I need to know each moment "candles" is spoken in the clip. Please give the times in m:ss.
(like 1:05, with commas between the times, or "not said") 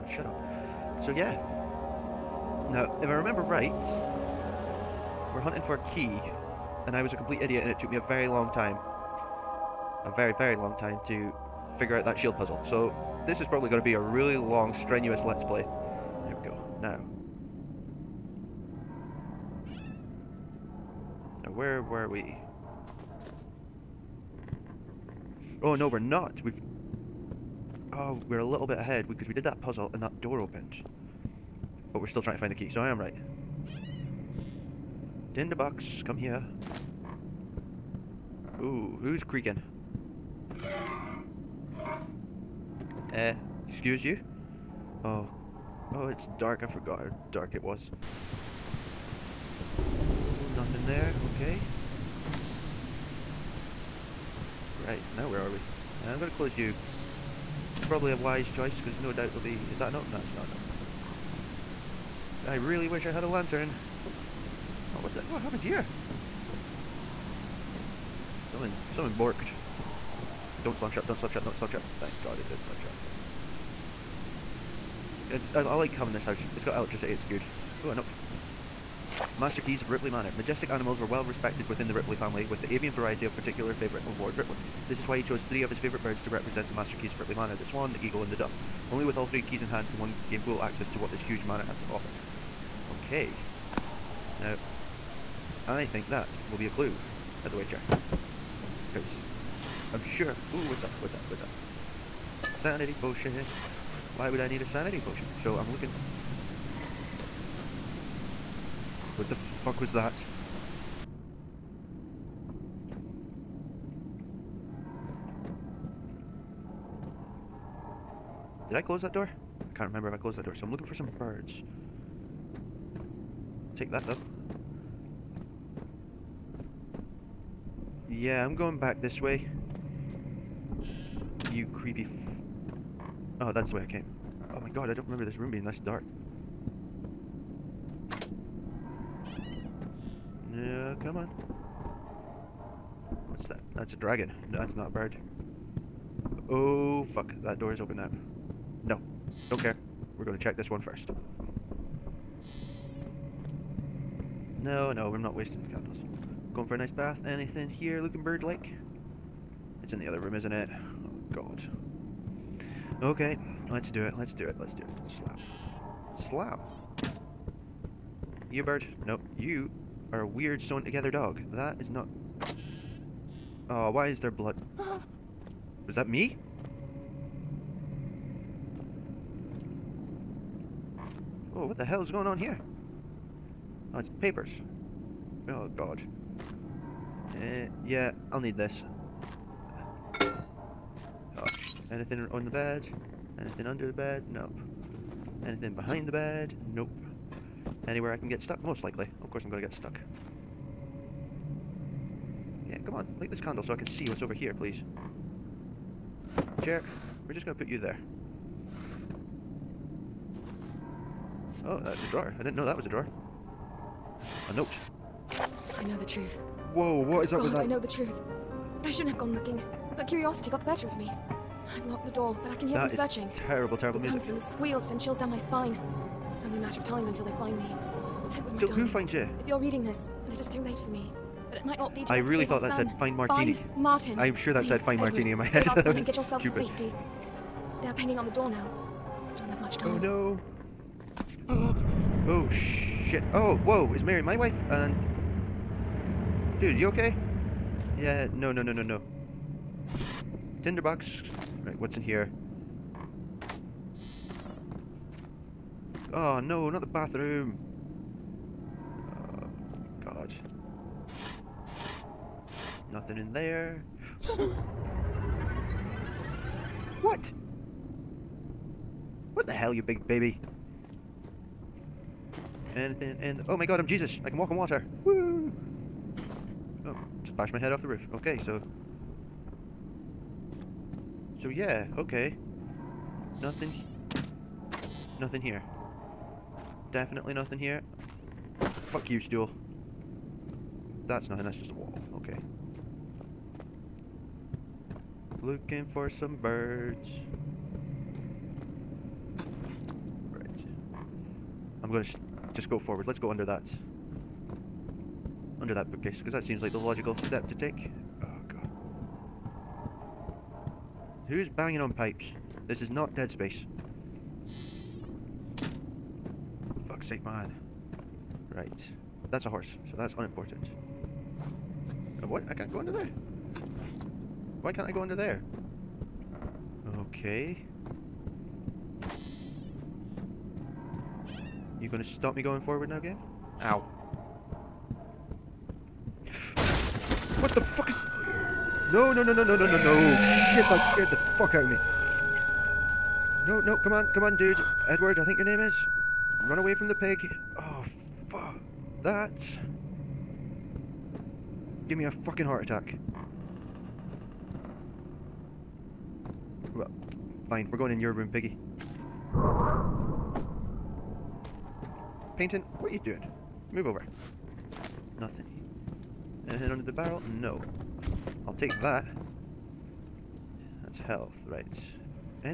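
2:35, 3:23.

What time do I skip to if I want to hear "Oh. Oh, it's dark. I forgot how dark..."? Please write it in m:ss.
0:45.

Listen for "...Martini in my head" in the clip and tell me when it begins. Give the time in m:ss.
3:55.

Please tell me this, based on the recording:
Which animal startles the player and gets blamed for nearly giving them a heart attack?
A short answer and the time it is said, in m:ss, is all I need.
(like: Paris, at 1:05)
pig, at 5:46.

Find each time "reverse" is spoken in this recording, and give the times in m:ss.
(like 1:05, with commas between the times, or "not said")
not said.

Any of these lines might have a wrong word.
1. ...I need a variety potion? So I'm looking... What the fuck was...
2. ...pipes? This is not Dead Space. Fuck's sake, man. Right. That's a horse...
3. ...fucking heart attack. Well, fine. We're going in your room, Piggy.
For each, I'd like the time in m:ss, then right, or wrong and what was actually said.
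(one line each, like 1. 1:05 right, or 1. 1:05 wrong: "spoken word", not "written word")
1. 1:44 wrong: "sanity", not "variety"
2. 5:11 right
3. 5:52 right.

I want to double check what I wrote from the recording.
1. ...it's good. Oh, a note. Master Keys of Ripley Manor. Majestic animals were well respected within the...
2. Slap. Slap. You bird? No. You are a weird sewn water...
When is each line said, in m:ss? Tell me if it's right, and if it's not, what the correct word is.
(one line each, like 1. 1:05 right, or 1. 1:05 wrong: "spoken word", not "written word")
1. 1:17 right
2. 2:46 wrong: "together", not "water".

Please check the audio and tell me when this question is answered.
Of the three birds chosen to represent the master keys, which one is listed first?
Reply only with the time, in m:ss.
1:27.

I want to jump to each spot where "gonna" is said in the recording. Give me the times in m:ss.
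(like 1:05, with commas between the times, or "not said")
5:01, 5:31.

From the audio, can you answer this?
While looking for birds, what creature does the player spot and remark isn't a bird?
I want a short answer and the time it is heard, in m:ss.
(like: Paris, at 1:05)
dragon, at 2:24.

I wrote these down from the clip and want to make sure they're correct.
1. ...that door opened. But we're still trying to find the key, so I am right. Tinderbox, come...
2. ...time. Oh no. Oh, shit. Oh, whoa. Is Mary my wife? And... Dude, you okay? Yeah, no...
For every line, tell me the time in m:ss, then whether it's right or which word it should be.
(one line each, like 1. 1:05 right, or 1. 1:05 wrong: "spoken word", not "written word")
1. 0:30 right
2. 3:59 right.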